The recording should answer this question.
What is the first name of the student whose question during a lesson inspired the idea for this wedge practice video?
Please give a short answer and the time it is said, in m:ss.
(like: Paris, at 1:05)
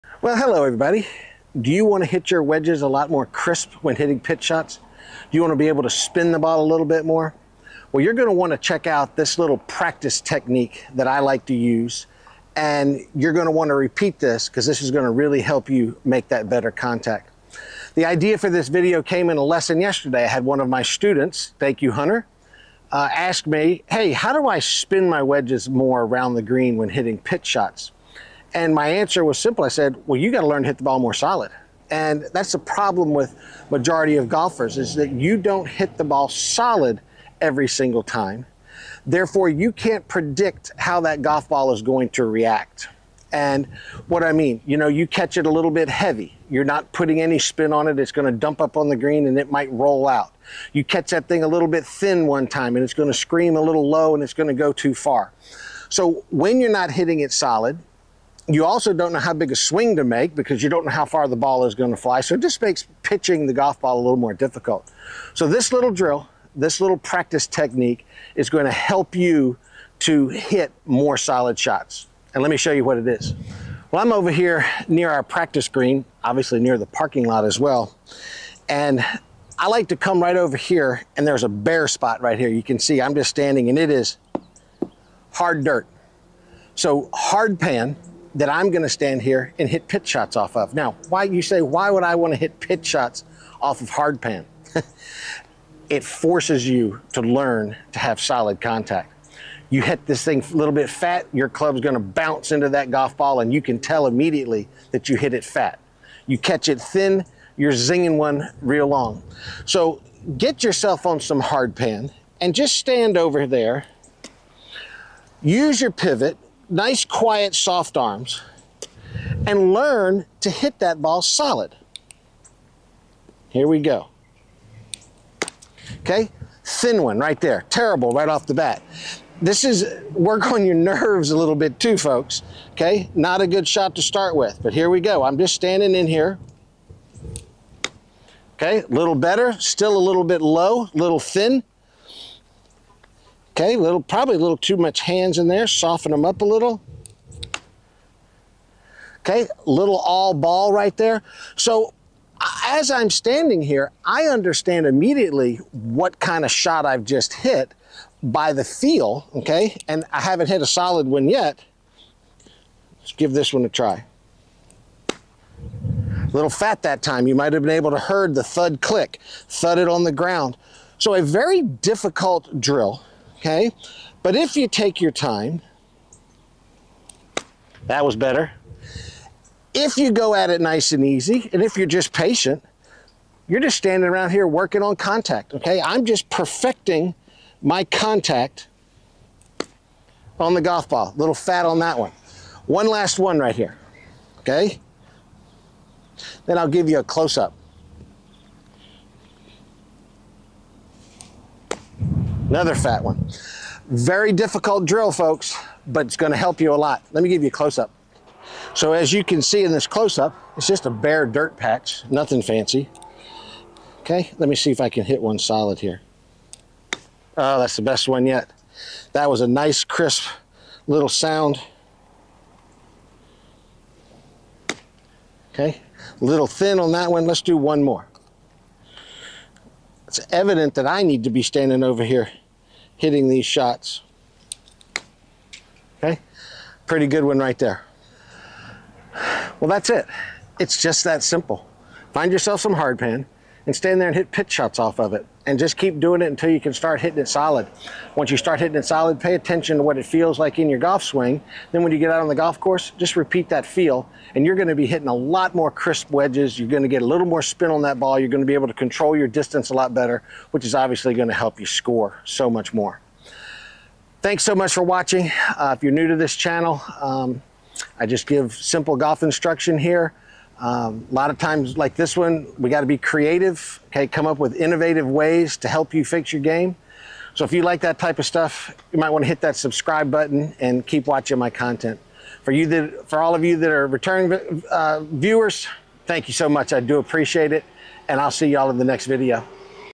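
Hunter, at 0:21.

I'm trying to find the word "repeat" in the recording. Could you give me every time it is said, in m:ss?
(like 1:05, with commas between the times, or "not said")
0:13, 4:13.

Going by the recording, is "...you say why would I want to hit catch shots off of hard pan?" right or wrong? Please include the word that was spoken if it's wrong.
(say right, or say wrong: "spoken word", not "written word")
wrong: "pitch", not "catch".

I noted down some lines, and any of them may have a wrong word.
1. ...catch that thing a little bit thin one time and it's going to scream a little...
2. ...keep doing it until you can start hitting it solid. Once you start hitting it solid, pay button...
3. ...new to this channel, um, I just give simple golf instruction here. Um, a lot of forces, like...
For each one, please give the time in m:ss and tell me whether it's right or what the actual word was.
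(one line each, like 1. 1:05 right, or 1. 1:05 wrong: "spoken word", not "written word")
1. 0:50 right
2. 4:05 wrong: "attention", not "button"
3. 4:25 wrong: "times", not "forces".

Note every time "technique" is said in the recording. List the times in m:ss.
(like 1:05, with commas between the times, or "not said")
0:10, 1:07.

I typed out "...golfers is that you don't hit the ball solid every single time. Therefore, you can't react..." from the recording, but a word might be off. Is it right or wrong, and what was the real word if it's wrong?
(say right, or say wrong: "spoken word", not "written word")
wrong: "predict", not "react".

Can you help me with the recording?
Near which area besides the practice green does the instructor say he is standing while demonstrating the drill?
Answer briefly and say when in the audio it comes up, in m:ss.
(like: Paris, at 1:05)
parking lot, at 1:16.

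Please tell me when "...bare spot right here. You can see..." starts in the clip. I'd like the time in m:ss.
1:21.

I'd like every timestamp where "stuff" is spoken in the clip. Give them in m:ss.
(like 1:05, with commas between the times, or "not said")
4:38.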